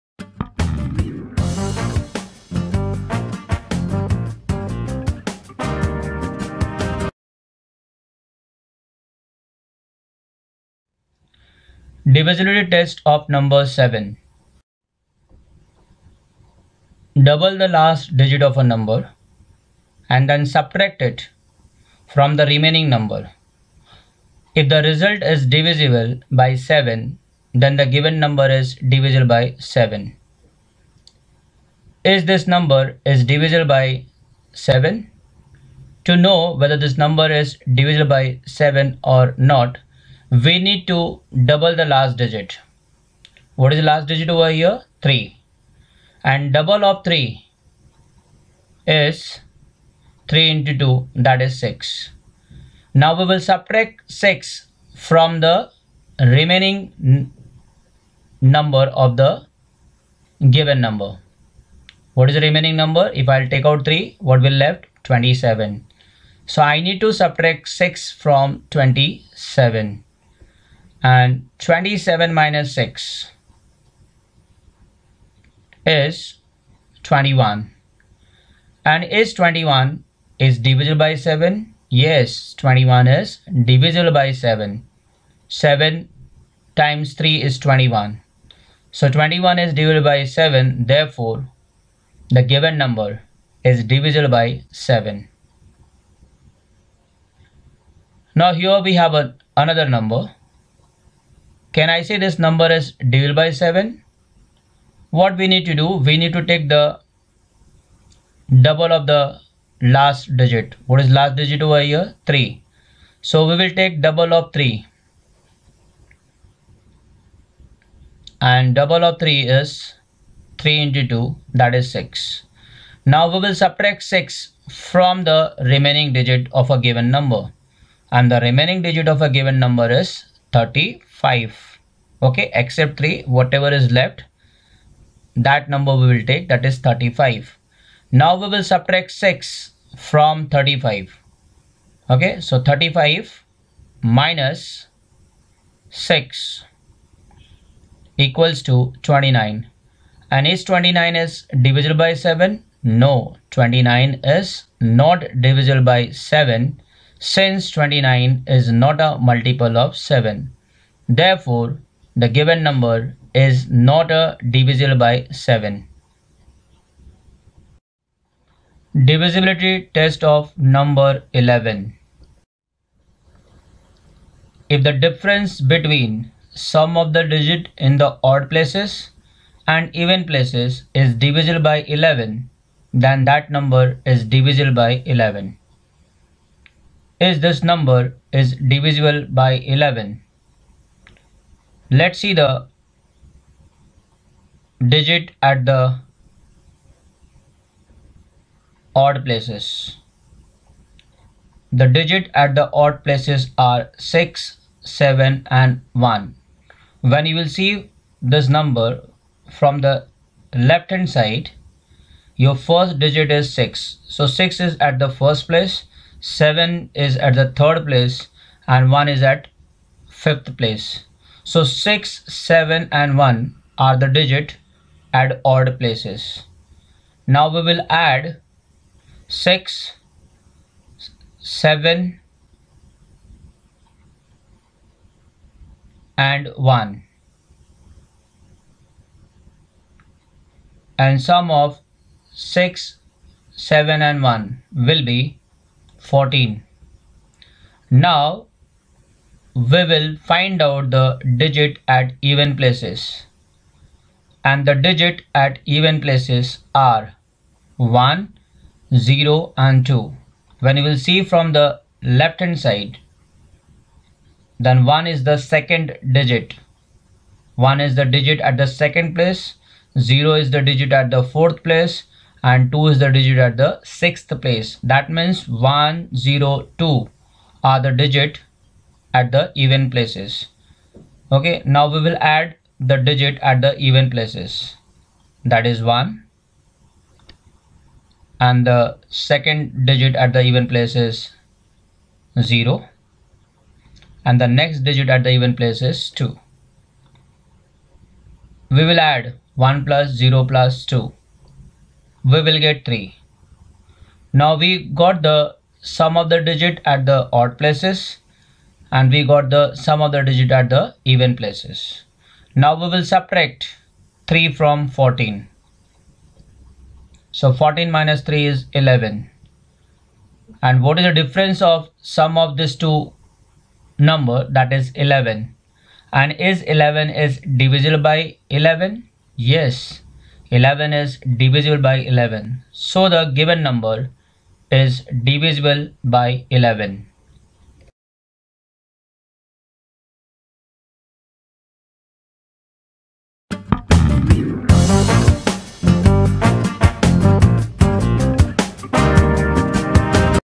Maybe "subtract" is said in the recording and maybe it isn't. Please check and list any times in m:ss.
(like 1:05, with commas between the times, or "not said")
0:20, 0:53, 1:07, 2:03, 2:18, 5:13.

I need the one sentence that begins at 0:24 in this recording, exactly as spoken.
If the result is divisible by 7, then the given number is divisible by 7.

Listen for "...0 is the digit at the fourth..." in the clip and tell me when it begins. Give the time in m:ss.
4:29.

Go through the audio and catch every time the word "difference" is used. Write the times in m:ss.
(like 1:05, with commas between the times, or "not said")
2:54, 5:21.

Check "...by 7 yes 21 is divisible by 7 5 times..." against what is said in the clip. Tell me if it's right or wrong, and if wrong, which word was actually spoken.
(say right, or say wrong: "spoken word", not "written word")
wrong: "7", not "5".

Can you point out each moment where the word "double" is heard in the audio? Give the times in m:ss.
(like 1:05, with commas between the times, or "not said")
0:17, 0:41, 0:46, 1:48, 1:54, 1:58.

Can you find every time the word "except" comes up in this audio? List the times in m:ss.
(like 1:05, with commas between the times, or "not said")
2:12.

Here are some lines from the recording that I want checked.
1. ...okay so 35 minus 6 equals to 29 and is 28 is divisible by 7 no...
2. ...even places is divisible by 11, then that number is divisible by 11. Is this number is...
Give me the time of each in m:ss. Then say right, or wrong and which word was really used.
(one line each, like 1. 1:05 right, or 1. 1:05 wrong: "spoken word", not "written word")
1. 2:22 wrong: "29", not "28"
2. 2:59 right.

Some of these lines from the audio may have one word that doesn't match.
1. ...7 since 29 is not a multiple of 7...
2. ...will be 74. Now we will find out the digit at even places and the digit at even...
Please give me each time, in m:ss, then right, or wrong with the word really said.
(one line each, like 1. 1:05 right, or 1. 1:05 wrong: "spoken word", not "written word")
1. 2:36 right
2. 4:04 wrong: "14", not "74".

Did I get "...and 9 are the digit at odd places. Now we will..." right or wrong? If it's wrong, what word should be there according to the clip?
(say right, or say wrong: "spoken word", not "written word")
wrong: "1", not "9".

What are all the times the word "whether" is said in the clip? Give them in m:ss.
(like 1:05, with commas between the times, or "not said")
0:36.